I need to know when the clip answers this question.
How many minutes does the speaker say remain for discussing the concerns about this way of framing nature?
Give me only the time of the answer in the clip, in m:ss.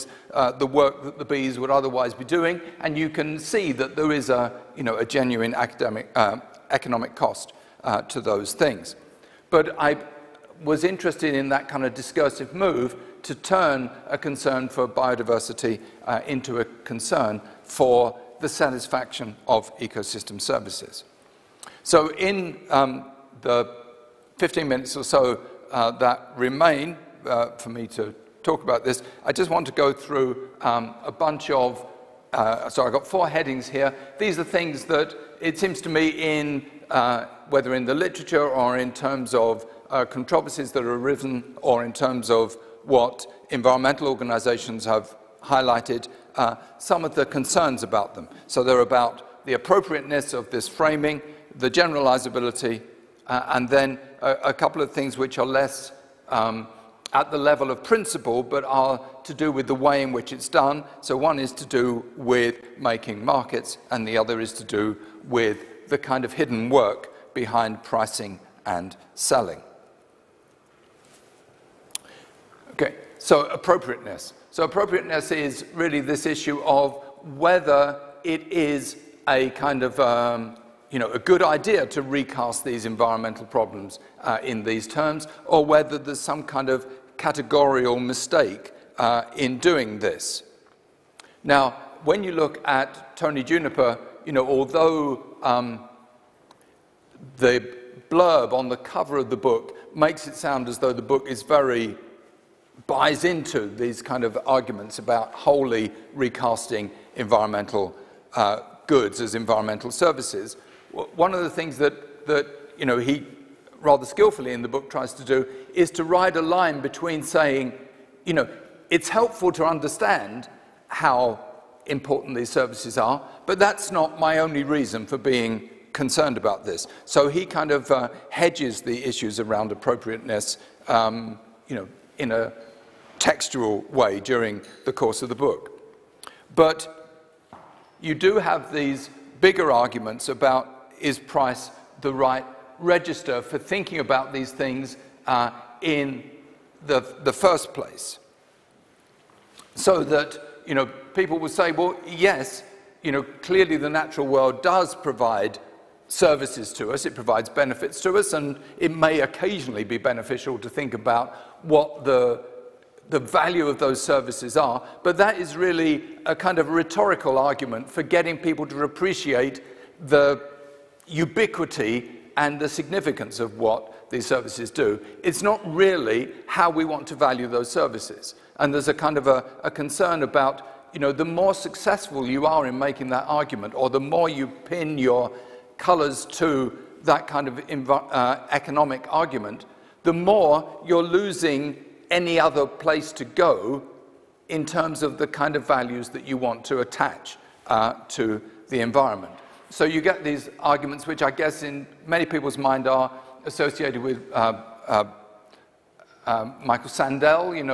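0:24.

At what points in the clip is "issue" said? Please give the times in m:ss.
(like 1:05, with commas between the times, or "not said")
1:16, 2:09.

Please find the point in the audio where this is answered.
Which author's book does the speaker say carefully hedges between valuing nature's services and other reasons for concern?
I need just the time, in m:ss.
1:33.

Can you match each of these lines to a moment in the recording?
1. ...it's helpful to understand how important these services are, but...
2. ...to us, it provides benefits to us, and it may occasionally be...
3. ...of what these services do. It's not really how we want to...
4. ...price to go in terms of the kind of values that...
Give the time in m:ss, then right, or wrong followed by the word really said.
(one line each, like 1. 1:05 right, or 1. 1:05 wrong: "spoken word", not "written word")
1. 1:58 right
2. 2:36 right
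3. 2:53 right
4. 3:12 wrong: "place", not "price".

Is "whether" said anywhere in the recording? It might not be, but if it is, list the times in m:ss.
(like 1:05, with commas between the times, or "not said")
0:37, 1:17, 1:25.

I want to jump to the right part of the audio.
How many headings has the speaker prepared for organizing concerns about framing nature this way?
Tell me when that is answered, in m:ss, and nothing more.
0:33.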